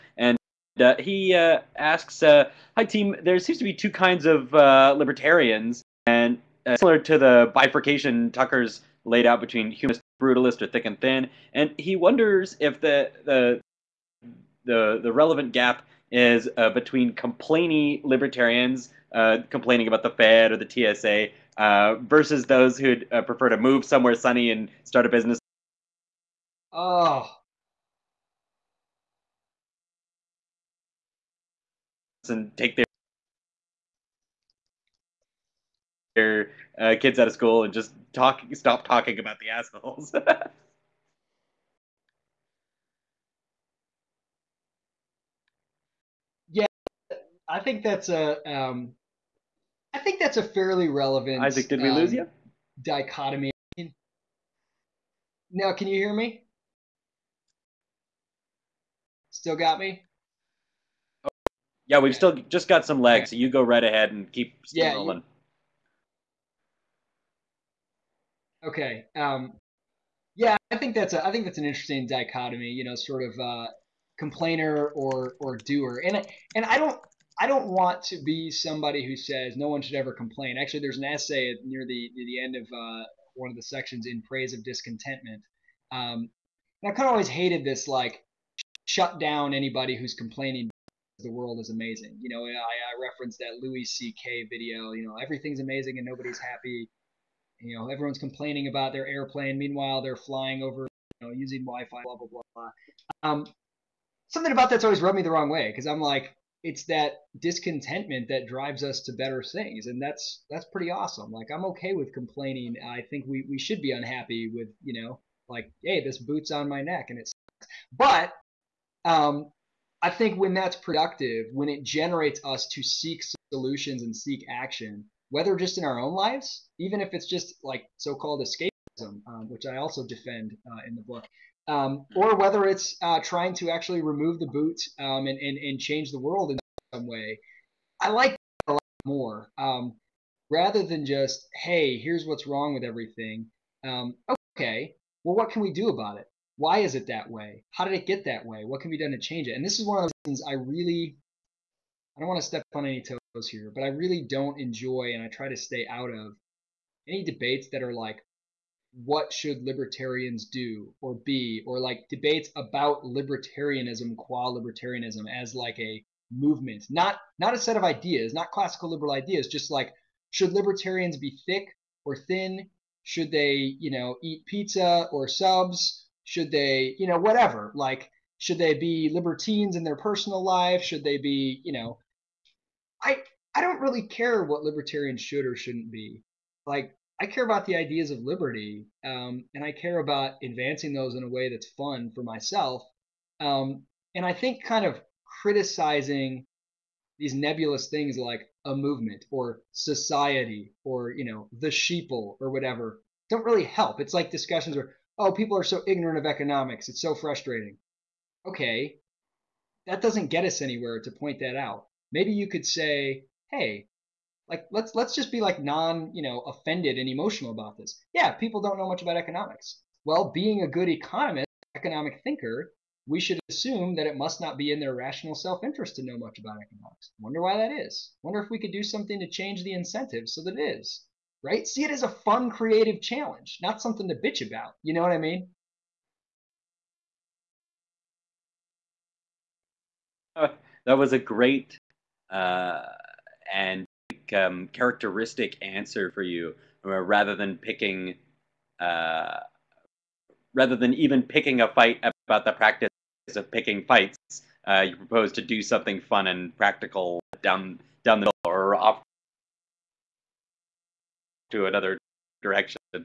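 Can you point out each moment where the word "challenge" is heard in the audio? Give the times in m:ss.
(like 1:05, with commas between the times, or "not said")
3:53.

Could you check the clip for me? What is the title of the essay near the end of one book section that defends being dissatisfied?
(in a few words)
In Praise of Discontentment.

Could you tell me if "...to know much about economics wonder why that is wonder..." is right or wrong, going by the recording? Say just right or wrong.
right.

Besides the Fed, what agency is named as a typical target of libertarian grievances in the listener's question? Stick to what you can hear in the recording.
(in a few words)
TSA.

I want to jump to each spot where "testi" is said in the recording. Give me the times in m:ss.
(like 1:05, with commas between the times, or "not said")
not said.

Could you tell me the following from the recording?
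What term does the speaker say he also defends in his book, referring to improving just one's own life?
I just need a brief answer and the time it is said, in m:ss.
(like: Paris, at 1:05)
escapism, at 2:08.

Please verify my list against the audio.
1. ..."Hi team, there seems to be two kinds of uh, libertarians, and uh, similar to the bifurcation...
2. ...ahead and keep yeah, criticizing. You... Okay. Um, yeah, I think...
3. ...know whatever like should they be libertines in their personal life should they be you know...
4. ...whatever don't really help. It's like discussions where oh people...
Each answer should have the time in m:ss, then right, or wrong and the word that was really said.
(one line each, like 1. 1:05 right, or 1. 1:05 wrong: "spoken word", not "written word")
1. 0:02 right
2. 1:03 wrong: "rolling", not "criticizing"
3. 2:57 right
4. 3:22 right.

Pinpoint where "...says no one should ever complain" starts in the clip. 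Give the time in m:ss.
1:19.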